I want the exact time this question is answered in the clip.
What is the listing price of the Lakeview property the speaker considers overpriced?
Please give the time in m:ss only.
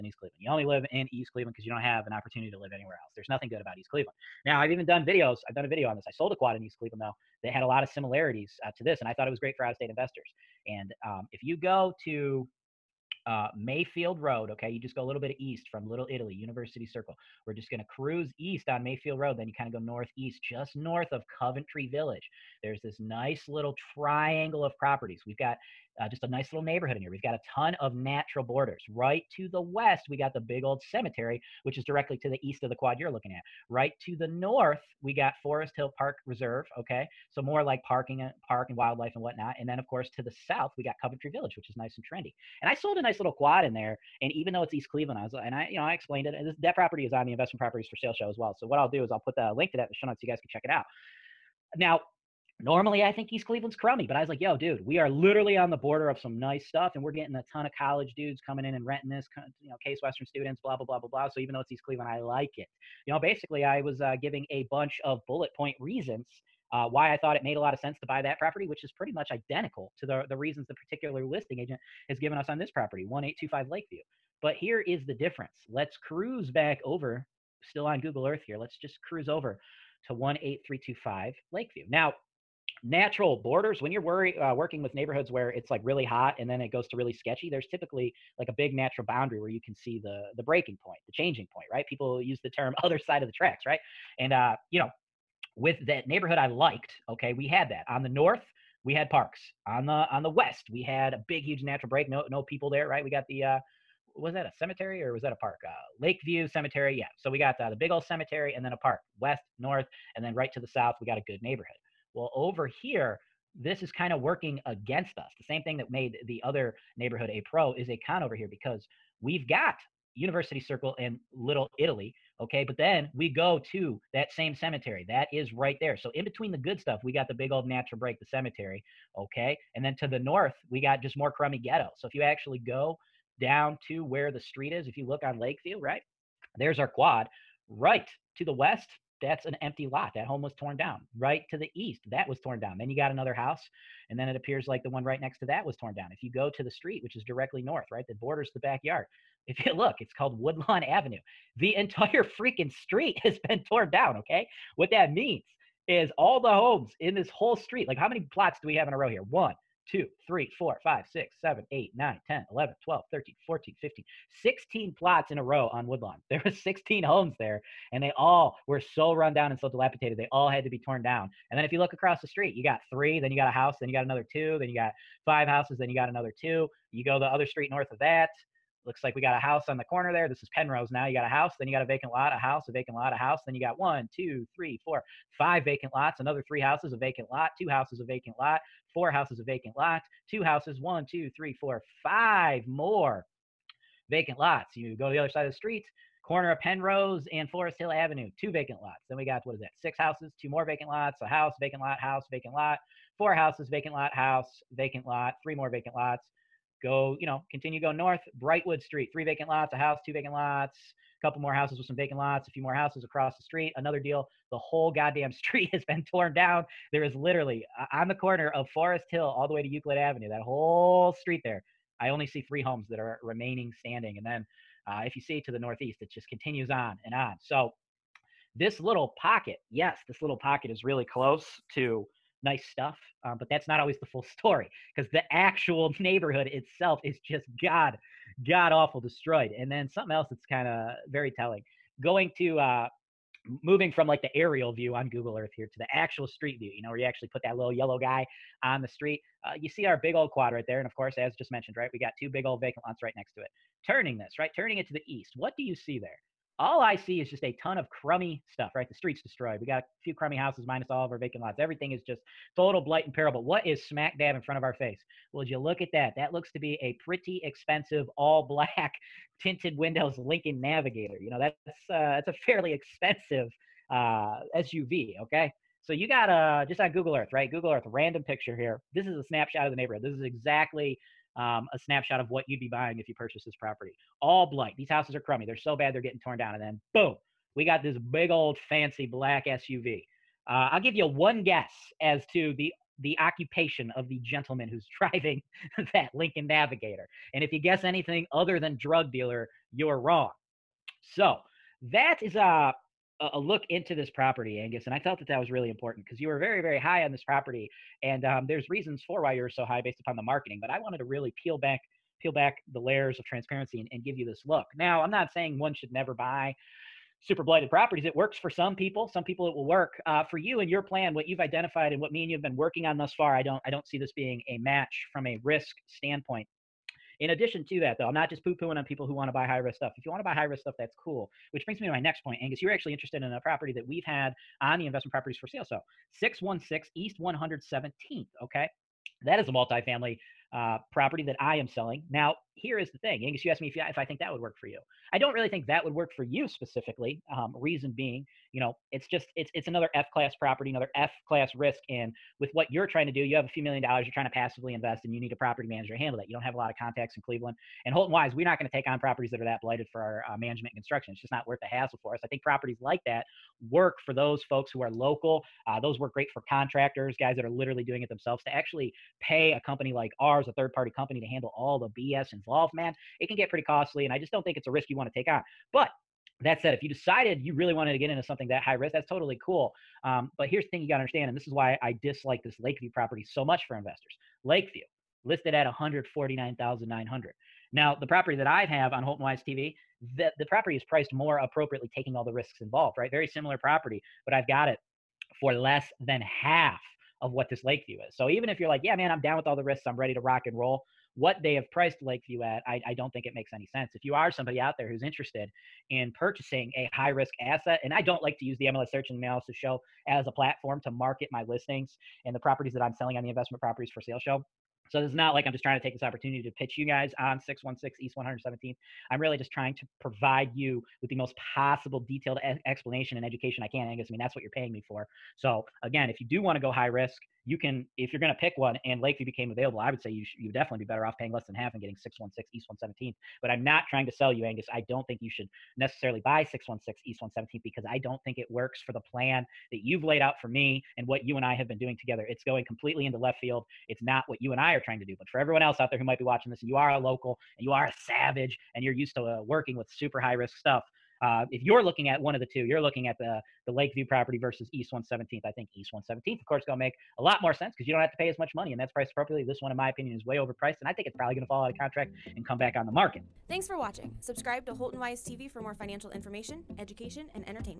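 6:25.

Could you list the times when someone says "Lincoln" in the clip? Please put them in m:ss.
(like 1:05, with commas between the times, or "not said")
4:30, 4:56.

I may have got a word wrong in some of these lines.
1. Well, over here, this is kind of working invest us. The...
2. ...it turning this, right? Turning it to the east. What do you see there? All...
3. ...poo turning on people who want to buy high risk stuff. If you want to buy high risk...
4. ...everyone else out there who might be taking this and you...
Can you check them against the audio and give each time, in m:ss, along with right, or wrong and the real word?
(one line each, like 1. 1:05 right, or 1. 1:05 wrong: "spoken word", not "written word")
1. 1:52 wrong: "against", not "invest"
2. 4:13 right
3. 5:28 wrong: "pooing", not "turning"
4. 7:25 wrong: "watching", not "taking".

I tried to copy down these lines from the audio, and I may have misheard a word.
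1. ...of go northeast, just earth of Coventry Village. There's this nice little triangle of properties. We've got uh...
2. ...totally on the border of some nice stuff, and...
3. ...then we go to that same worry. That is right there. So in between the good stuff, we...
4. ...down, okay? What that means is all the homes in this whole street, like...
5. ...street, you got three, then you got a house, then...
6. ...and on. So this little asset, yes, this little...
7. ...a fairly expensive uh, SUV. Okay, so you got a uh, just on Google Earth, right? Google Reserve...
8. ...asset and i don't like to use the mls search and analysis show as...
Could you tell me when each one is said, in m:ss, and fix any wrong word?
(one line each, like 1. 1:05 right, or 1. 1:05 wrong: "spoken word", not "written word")
1. 0:19 wrong: "north", not "earth"
2. 0:55 wrong: "literally", not "totally"
3. 2:02 wrong: "cemetery", not "worry"
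4. 2:33 right
5. 2:52 right
6. 3:47 wrong: "pocket", not "asset"
7. 4:32 wrong: "Earth", not "Reserve"
8. 6:47 right.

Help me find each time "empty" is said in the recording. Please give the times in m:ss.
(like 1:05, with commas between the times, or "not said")
2:19.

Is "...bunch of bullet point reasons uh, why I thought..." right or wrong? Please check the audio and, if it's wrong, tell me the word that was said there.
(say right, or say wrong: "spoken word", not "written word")
right.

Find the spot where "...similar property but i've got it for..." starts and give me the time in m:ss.
6:33.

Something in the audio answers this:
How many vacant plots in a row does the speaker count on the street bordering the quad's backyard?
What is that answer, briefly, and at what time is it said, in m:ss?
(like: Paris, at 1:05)
16, at 2:44.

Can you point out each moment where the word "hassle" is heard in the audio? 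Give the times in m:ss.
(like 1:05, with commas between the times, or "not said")
6:01.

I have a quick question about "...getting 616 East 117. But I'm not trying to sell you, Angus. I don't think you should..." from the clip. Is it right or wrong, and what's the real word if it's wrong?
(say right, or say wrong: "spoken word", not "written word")
right.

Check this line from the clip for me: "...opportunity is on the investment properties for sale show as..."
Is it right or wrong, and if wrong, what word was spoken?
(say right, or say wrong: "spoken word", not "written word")
wrong: "property", not "opportunity".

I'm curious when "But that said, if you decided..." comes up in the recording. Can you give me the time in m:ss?
6:15.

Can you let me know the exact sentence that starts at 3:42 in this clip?
I only see three homes that are remaining standing.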